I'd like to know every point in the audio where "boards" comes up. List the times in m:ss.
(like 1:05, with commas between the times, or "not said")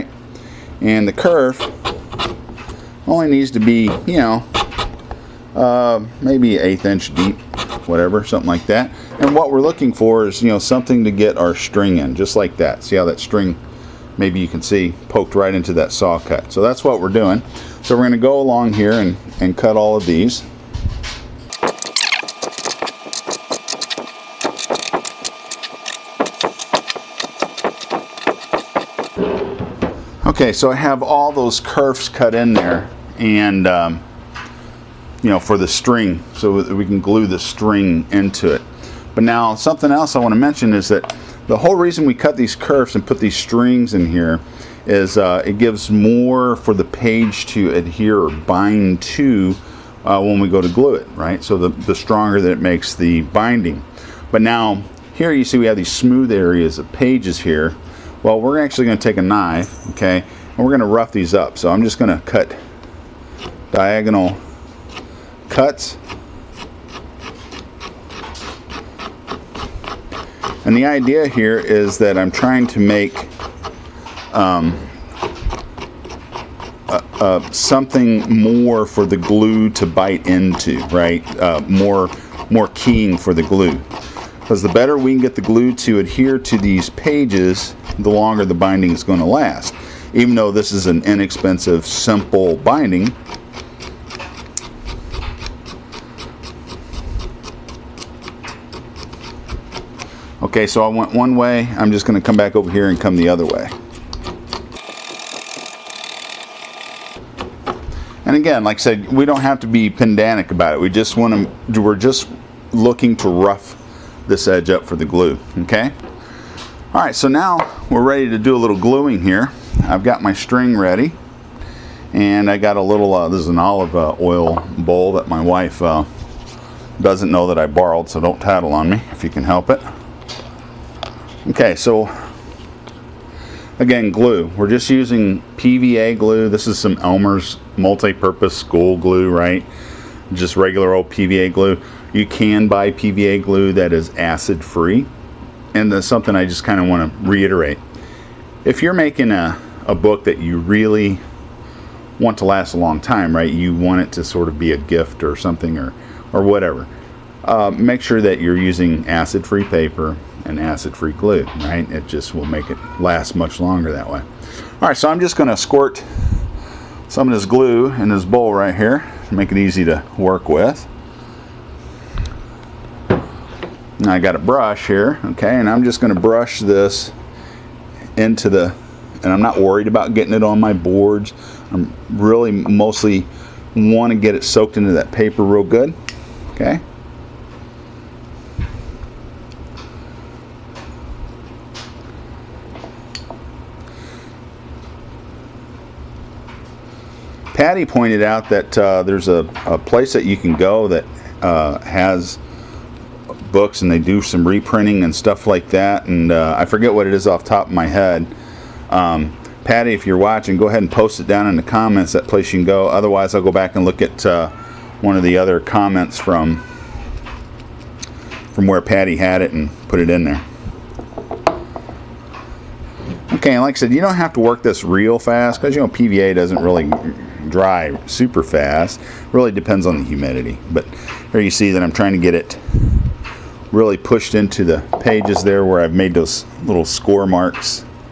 3:00.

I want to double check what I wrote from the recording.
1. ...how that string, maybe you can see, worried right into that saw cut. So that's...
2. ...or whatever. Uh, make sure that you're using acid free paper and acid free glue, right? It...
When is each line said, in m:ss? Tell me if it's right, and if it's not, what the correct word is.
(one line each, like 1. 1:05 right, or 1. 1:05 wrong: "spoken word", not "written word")
1. 0:12 wrong: "poked", not "worried"
2. 2:36 right.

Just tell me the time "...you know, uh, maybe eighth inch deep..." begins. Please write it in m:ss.
0:04.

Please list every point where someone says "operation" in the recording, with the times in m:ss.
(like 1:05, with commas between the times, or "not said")
not said.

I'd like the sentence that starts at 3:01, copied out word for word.
I'm really mostly want to get it soaked into that paper real good, okay.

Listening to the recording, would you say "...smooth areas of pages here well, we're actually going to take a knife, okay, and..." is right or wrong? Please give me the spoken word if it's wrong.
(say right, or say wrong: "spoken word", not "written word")
right.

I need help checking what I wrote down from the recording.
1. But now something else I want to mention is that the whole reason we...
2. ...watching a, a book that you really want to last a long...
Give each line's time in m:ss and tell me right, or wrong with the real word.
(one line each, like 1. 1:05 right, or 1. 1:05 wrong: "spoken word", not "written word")
1. 0:39 right
2. 2:28 wrong: "making", not "watching".